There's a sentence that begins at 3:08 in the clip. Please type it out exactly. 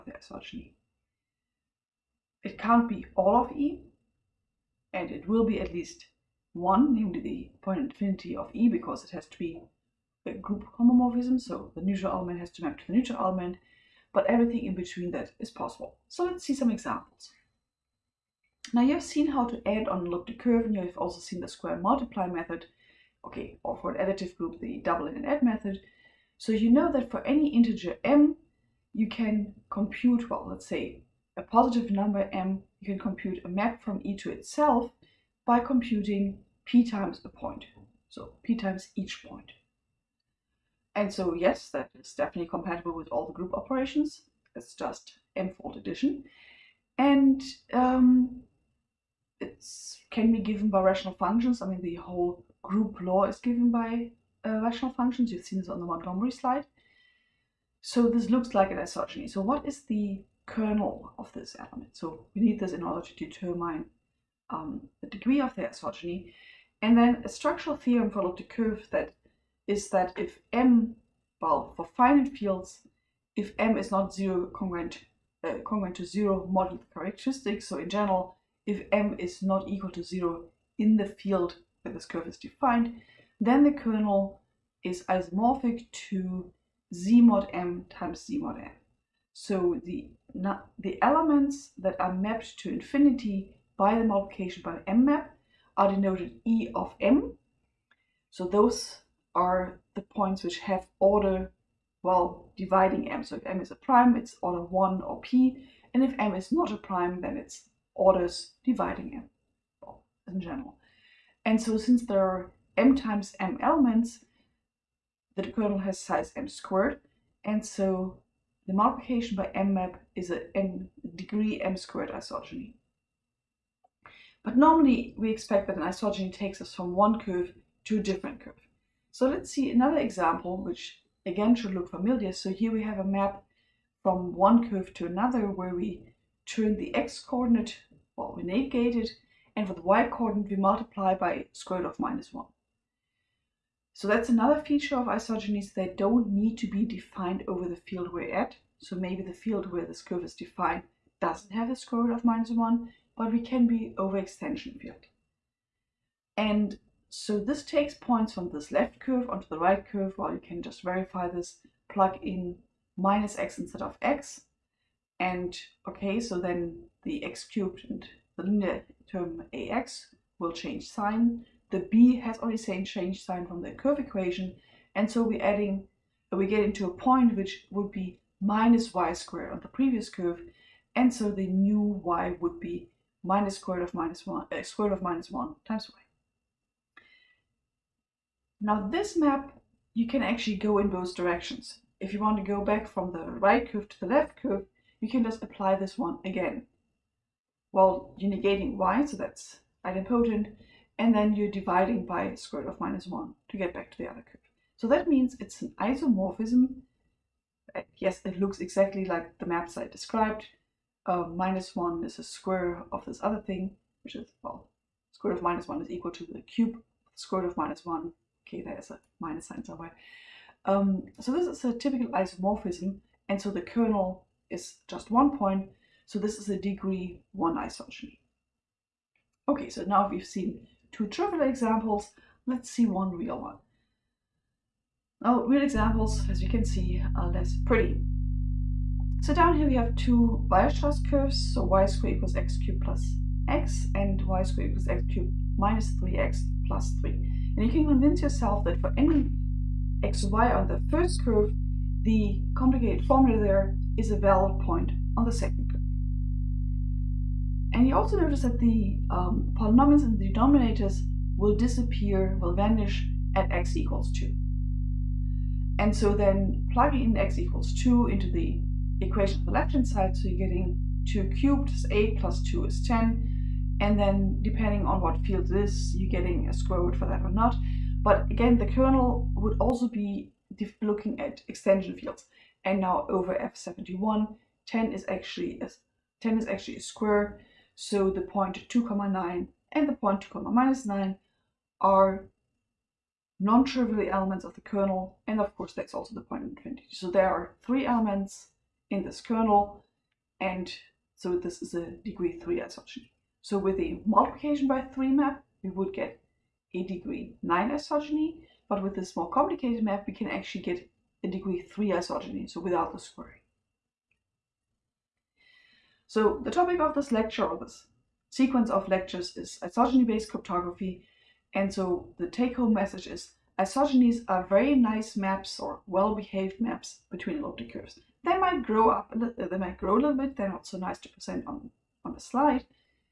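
Now this map, you can actually go in both directions.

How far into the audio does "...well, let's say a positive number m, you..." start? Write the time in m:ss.
0:30.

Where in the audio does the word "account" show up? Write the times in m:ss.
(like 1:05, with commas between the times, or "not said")
not said.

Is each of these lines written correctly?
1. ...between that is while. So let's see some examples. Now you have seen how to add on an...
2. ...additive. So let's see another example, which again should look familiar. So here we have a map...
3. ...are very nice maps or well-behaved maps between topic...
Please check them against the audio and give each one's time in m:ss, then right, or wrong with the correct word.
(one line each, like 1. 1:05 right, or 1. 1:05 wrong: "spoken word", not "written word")
1. 0:14 wrong: "possible", not "while"
2. 2:08 wrong: "curve", not "additive"
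3. 5:24 wrong: "elliptic", not "topic".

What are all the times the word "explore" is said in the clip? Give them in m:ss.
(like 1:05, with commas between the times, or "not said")
not said.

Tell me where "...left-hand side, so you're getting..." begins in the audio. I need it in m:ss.
4:29.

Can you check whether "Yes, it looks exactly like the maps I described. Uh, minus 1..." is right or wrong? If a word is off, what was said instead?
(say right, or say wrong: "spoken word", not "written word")
right.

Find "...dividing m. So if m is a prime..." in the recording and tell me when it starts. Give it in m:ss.
1:42.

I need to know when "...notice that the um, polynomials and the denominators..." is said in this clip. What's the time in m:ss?
4:18.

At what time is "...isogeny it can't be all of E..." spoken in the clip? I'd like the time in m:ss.
0:00.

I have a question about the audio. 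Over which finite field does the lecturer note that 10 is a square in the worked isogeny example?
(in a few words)
F71.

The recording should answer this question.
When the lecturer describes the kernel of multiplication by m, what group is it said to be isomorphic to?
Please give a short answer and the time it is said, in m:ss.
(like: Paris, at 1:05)
Z mod M times Z mod M, at 1:26.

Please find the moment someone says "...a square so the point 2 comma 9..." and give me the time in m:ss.
4:46.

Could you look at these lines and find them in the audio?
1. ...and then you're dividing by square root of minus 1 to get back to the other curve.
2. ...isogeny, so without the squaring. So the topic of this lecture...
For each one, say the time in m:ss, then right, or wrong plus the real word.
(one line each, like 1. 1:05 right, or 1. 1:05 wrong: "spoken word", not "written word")
1. 3:21 right
2. 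5:11 right.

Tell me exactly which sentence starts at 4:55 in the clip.
And of course, that's also the point infinity.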